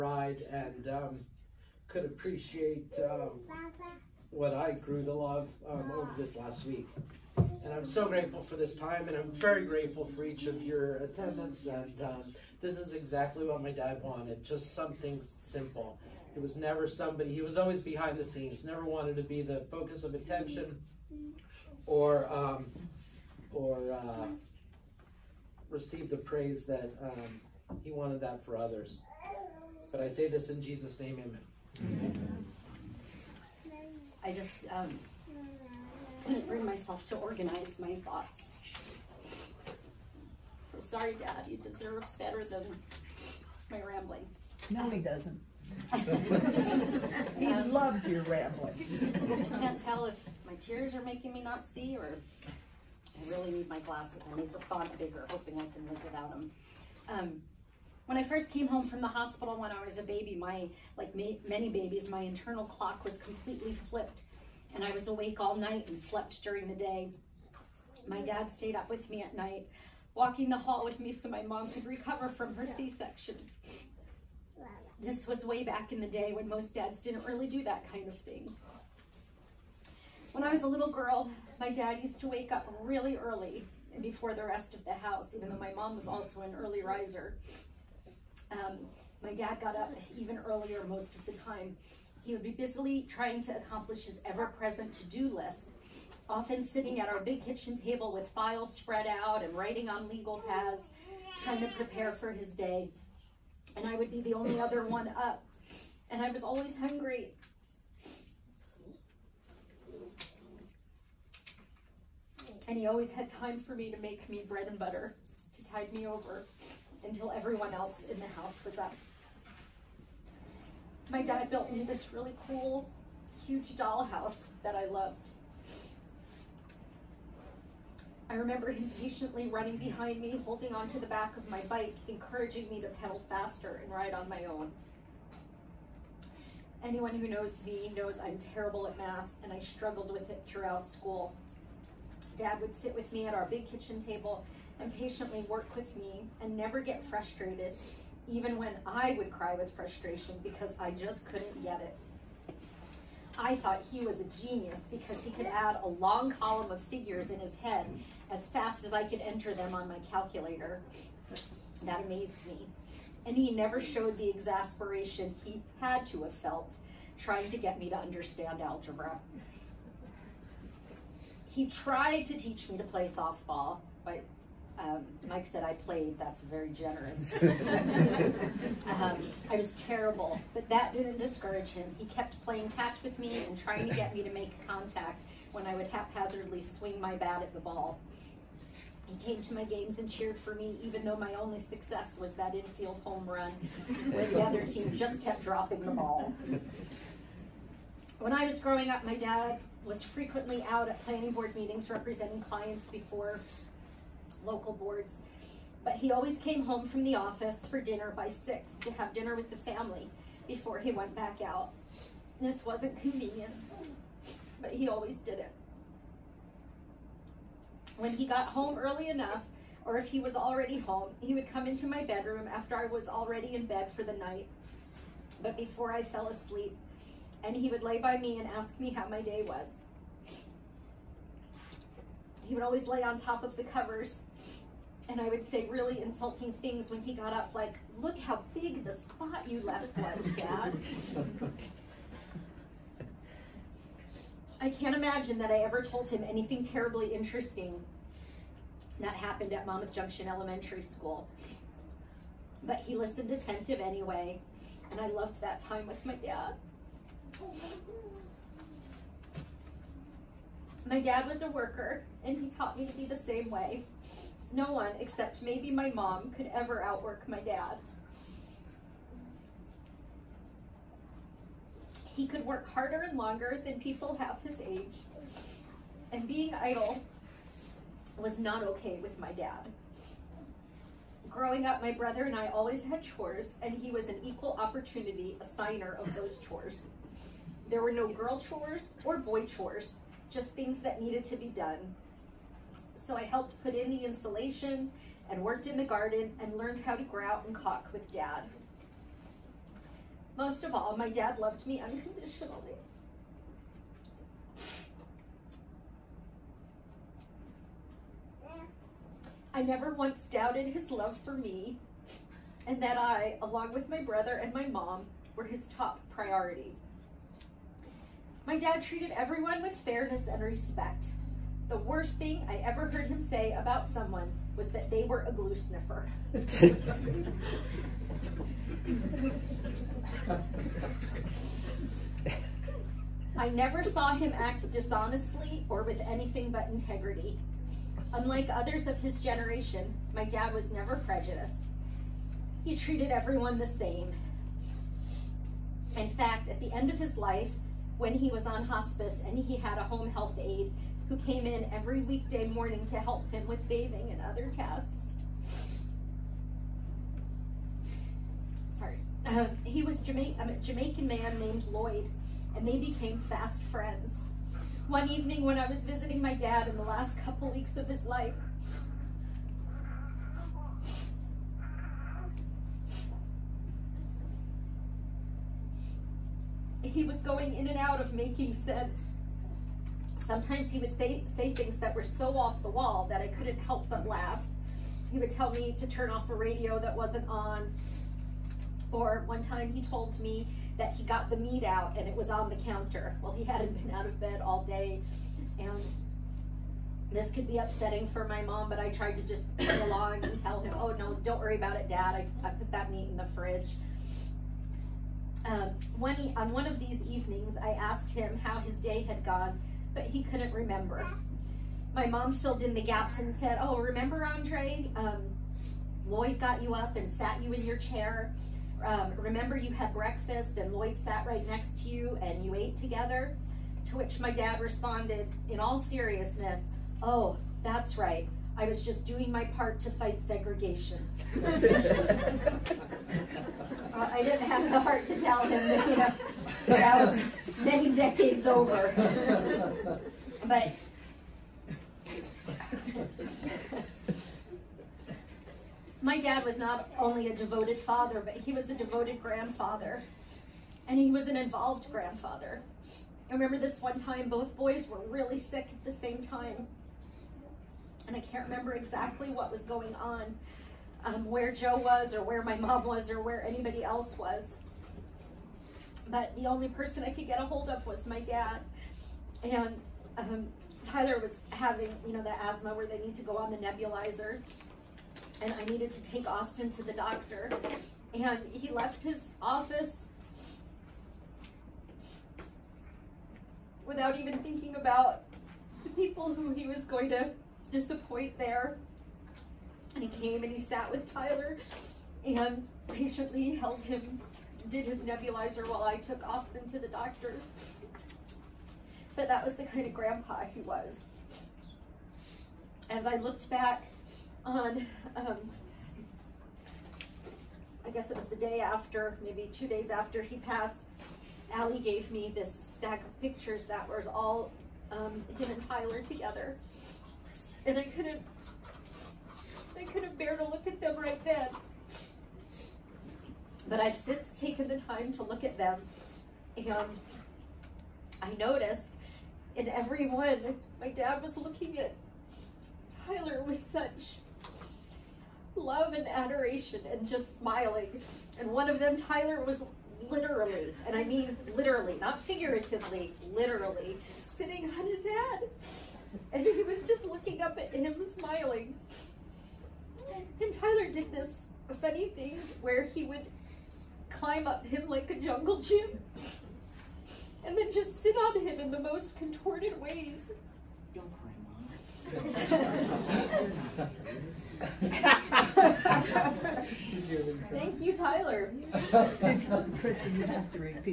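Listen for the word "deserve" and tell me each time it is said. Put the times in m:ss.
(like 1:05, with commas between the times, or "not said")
0:41.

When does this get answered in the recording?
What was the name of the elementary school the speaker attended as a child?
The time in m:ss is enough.
4:09.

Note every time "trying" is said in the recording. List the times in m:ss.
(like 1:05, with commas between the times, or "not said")
1:33, 1:41, 2:47, 3:03.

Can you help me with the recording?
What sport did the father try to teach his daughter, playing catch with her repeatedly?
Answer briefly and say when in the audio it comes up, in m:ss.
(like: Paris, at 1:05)
softball, at 2:53.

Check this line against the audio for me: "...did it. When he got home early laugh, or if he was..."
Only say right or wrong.
wrong.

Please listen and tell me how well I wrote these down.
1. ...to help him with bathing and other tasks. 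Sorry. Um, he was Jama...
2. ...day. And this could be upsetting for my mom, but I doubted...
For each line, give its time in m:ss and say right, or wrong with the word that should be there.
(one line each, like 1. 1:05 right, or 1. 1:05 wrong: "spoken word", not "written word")
1. 5:52 right
2. 6:34 wrong: "tried", not "doubted".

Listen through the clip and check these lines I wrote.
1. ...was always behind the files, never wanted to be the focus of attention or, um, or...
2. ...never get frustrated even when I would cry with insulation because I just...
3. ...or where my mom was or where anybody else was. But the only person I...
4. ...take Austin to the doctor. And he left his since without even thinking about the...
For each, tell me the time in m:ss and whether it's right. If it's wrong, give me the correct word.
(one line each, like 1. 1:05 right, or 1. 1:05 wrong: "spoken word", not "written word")
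1. 0:17 wrong: "scenes", not "files"
2. 2:26 wrong: "frustration", not "insulation"
3. 7:42 right
4. 7:56 wrong: "office", not "since".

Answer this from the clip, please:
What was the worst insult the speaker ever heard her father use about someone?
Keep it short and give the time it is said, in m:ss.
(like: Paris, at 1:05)
glue sniffer, at 5:25.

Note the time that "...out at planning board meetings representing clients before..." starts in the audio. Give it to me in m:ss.
3:20.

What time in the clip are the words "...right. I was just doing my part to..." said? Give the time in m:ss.
7:07.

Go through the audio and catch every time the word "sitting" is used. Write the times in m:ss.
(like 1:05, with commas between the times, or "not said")
1:36, 9:04.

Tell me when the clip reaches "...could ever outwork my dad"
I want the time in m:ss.
4:26.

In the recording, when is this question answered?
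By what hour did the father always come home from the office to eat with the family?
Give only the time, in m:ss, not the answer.
3:28.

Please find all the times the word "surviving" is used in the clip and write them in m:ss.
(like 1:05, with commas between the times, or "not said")
not said.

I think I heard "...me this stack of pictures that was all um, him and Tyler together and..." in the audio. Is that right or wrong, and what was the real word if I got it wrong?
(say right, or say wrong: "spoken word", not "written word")
right.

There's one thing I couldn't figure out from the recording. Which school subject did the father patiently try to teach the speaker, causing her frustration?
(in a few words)
algebra.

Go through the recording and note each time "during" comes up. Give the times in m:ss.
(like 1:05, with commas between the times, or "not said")
1:06.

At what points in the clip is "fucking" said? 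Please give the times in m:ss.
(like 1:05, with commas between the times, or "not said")
not said.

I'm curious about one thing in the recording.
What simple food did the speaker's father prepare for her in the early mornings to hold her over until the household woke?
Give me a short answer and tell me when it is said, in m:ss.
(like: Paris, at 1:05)
bread and butter, at 1:54.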